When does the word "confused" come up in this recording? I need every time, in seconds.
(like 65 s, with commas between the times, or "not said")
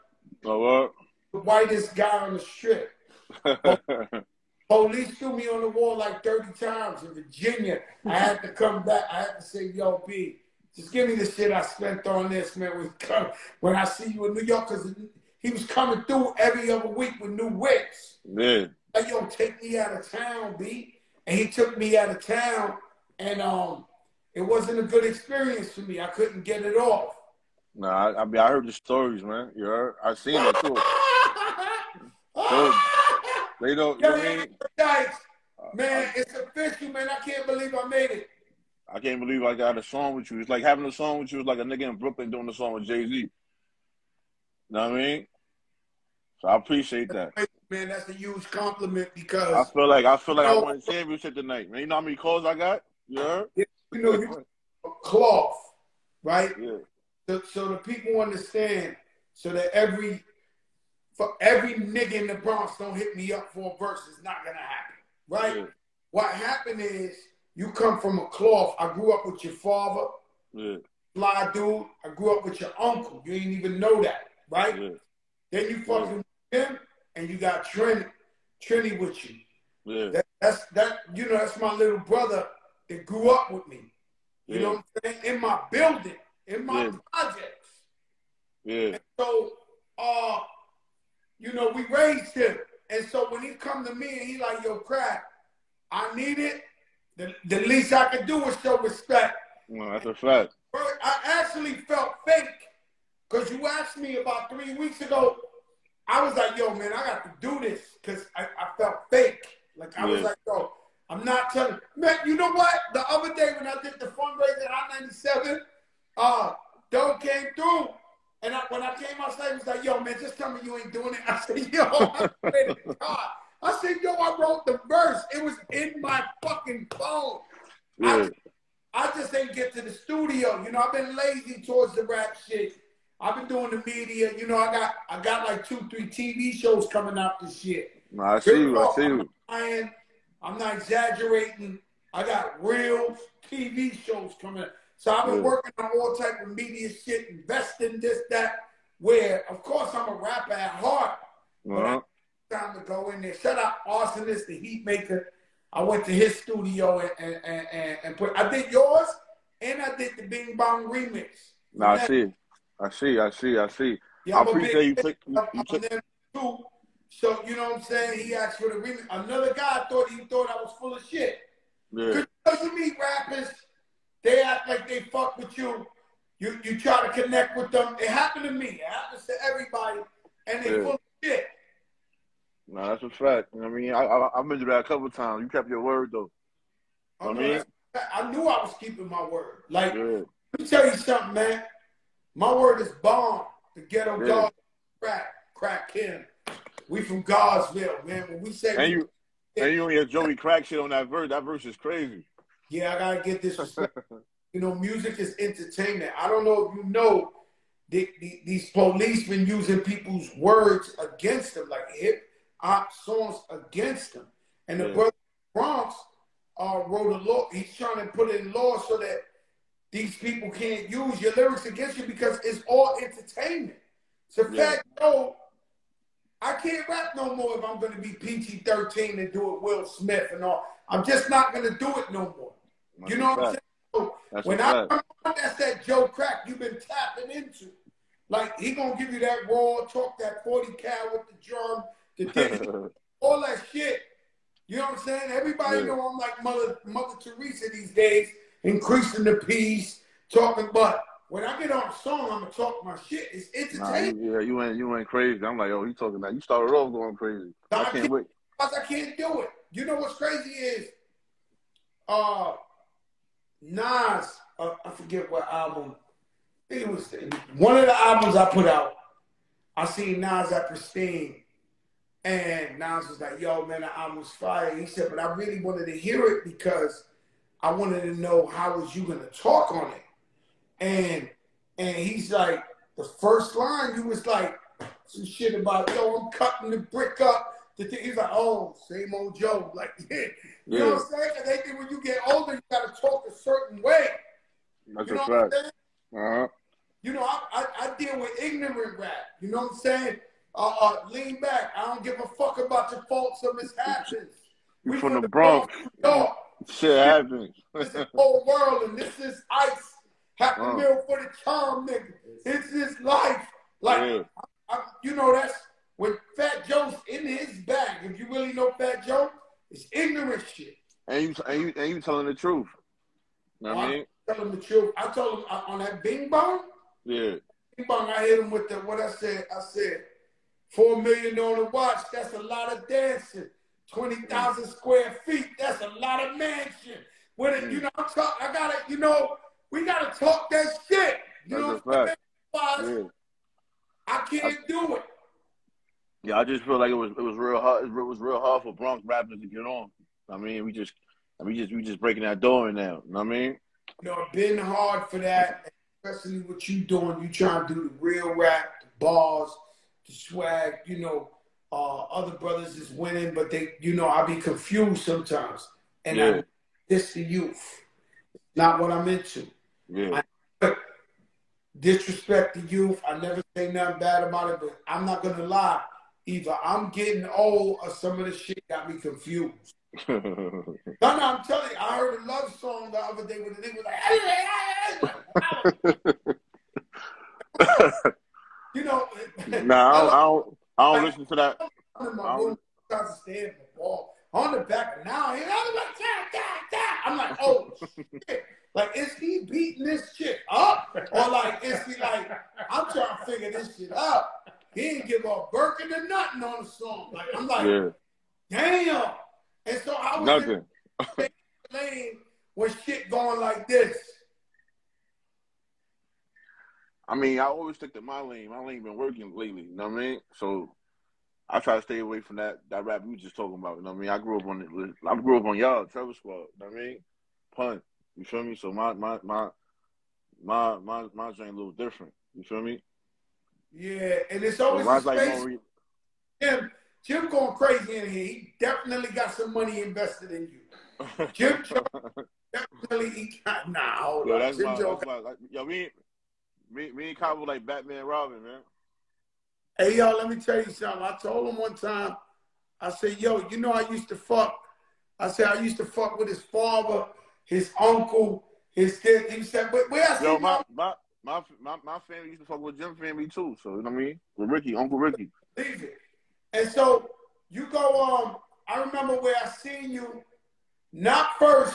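364 s, 378 s.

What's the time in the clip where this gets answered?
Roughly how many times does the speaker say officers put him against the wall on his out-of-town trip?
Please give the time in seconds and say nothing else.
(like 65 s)
6 s.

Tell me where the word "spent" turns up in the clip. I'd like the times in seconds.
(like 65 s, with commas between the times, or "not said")
11 s.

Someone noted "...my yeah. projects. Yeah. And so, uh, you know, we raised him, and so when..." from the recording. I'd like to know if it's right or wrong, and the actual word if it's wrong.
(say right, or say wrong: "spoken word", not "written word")
right.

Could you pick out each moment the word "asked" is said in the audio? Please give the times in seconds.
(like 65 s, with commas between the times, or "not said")
103 s, 168 s.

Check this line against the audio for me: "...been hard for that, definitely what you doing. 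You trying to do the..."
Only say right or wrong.
wrong.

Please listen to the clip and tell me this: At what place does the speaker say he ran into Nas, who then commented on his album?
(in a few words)
Pristine.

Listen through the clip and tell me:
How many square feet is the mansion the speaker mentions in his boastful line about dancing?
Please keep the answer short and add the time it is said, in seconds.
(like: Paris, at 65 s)
20,000 square feet, at 333 s.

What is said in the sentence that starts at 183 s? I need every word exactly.
I, I, have been that a couple times.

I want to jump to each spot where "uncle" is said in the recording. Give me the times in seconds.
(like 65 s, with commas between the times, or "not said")
72 s, 457 s, 464 s.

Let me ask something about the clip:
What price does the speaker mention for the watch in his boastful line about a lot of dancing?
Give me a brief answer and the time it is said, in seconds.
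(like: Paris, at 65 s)
$4 million, at 330 s.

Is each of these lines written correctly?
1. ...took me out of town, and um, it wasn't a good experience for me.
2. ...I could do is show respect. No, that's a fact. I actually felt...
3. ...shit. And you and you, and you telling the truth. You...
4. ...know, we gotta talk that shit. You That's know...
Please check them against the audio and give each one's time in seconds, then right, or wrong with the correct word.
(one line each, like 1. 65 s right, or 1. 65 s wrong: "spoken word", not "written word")
1. 21 s right
2. 97 s right
3. 320 s right
4. 338 s right.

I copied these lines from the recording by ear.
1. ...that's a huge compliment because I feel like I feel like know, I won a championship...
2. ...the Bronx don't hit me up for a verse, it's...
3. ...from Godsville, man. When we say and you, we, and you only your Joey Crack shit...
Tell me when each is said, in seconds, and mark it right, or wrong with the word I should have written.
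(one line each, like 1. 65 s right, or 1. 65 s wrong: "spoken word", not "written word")
1. 47 s right
2. 62 s right
3. 197 s right.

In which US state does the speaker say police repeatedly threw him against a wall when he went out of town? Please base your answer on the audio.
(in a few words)
Virginia.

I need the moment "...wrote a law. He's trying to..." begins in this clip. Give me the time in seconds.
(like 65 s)
216 s.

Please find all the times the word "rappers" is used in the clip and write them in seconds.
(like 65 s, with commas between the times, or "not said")
150 s, 172 s, 349 s.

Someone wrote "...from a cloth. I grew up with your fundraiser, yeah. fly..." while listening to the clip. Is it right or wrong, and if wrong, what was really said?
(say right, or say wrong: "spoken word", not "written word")
wrong: "father", not "fundraiser".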